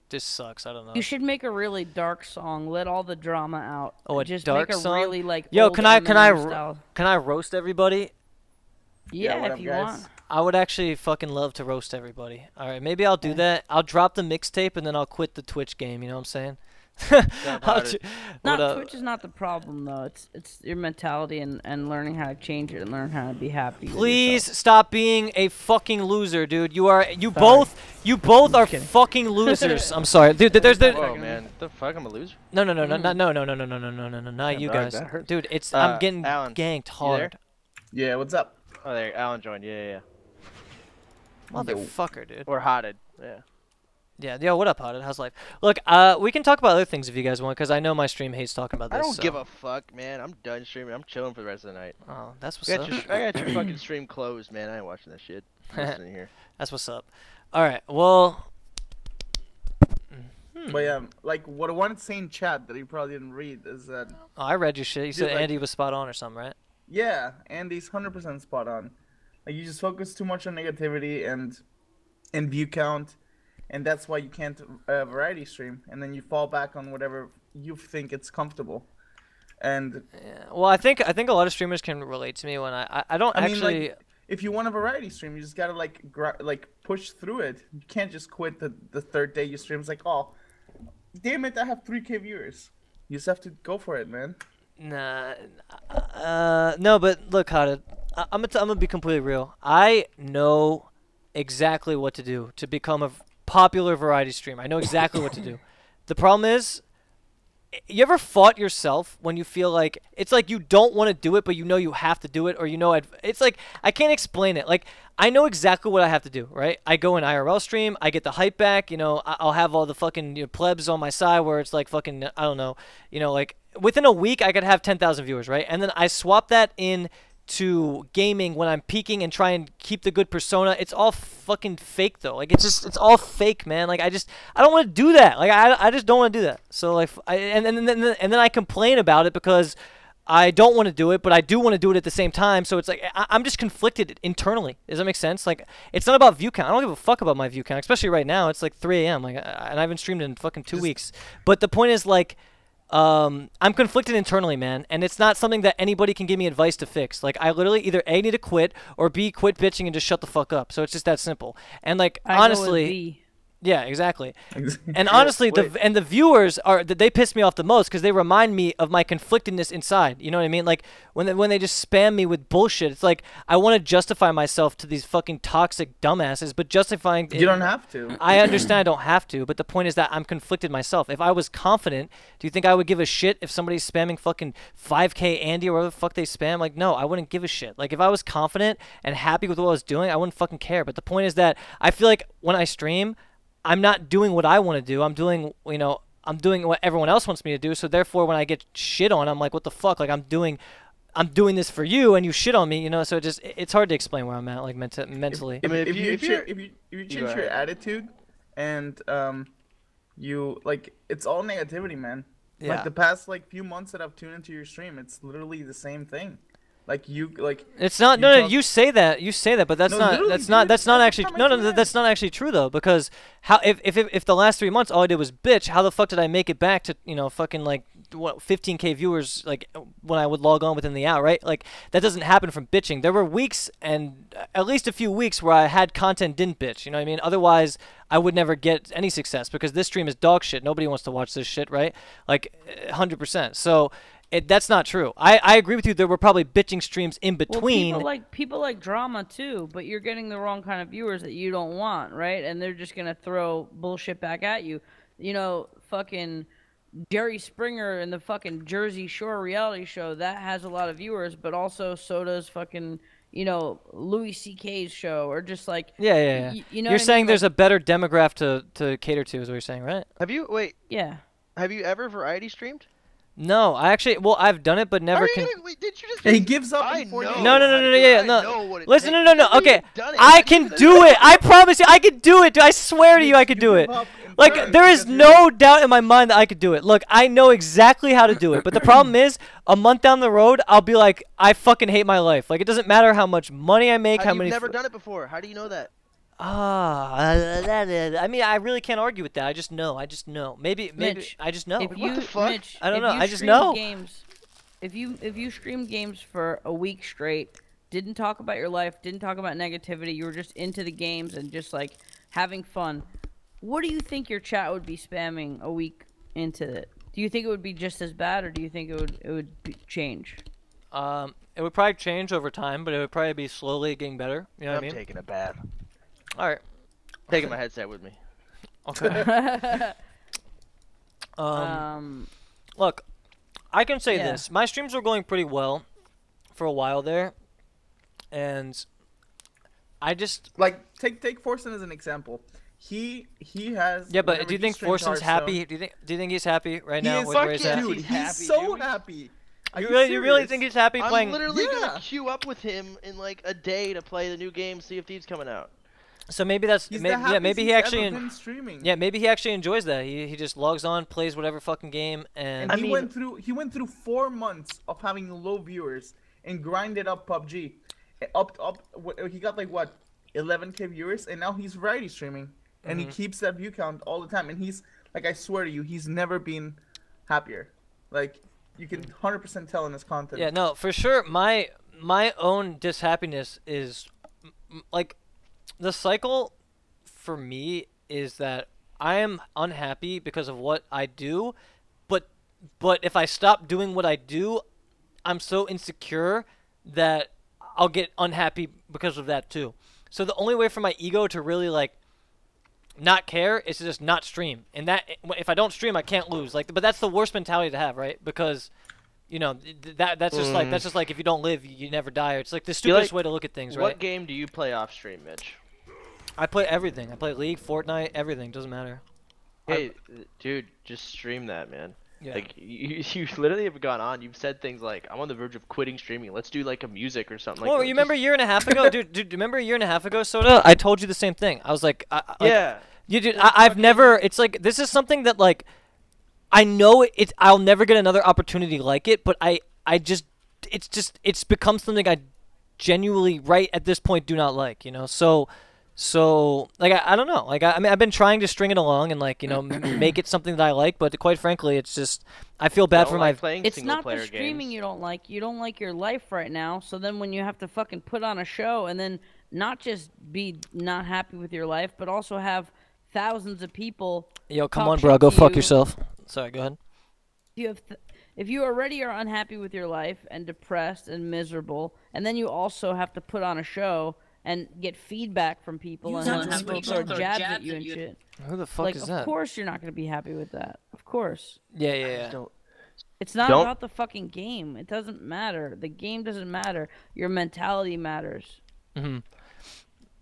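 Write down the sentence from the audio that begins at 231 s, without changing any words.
Like that doesn't happen from bitching.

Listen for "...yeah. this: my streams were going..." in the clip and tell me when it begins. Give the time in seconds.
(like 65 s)
334 s.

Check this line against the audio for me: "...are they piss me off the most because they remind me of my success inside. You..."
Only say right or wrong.
wrong.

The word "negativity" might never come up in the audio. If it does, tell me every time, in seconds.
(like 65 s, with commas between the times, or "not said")
70 s, 211 s, 309 s.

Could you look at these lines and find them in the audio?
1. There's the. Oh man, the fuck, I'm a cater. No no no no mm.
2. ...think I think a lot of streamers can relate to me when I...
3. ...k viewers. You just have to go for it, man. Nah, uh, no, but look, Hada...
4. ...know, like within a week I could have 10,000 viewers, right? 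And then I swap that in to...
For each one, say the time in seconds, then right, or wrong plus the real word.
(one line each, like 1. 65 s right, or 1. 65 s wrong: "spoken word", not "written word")
1. 30 s wrong: "loser", not "cater"
2. 80 s right
3. 92 s right
4. 123 s right.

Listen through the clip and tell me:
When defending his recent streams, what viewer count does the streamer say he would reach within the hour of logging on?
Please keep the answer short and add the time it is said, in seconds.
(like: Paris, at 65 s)
15k, at 228 s.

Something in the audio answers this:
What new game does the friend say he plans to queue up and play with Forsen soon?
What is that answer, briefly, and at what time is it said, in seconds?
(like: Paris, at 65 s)
Sea of Thieves, at 354 s.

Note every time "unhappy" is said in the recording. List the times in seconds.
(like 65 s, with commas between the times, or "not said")
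389 s, 398 s, 469 s.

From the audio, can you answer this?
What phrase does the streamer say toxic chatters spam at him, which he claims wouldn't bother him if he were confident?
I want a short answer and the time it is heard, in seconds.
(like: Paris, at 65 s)
5K Andy, at 184 s.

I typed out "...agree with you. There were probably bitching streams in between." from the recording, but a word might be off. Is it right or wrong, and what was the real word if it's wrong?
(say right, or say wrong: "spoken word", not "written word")
right.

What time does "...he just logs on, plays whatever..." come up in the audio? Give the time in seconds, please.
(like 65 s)
360 s.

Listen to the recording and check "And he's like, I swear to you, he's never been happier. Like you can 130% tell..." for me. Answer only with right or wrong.
wrong.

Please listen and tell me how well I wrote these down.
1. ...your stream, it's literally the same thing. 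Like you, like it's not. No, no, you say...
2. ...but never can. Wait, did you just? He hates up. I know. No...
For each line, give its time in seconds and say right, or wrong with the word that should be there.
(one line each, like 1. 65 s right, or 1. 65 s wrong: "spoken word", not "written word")
1. 214 s right
2. 274 s wrong: "gives", not "hates".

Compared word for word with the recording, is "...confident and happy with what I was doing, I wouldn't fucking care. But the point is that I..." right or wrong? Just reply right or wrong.
right.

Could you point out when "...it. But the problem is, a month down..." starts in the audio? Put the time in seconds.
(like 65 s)
288 s.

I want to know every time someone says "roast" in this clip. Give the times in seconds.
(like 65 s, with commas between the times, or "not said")
7 s, 11 s.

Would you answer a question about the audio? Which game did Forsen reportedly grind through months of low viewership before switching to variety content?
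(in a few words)
PUBG.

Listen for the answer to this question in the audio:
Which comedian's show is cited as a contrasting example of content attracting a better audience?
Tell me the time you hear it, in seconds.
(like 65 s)
263 s.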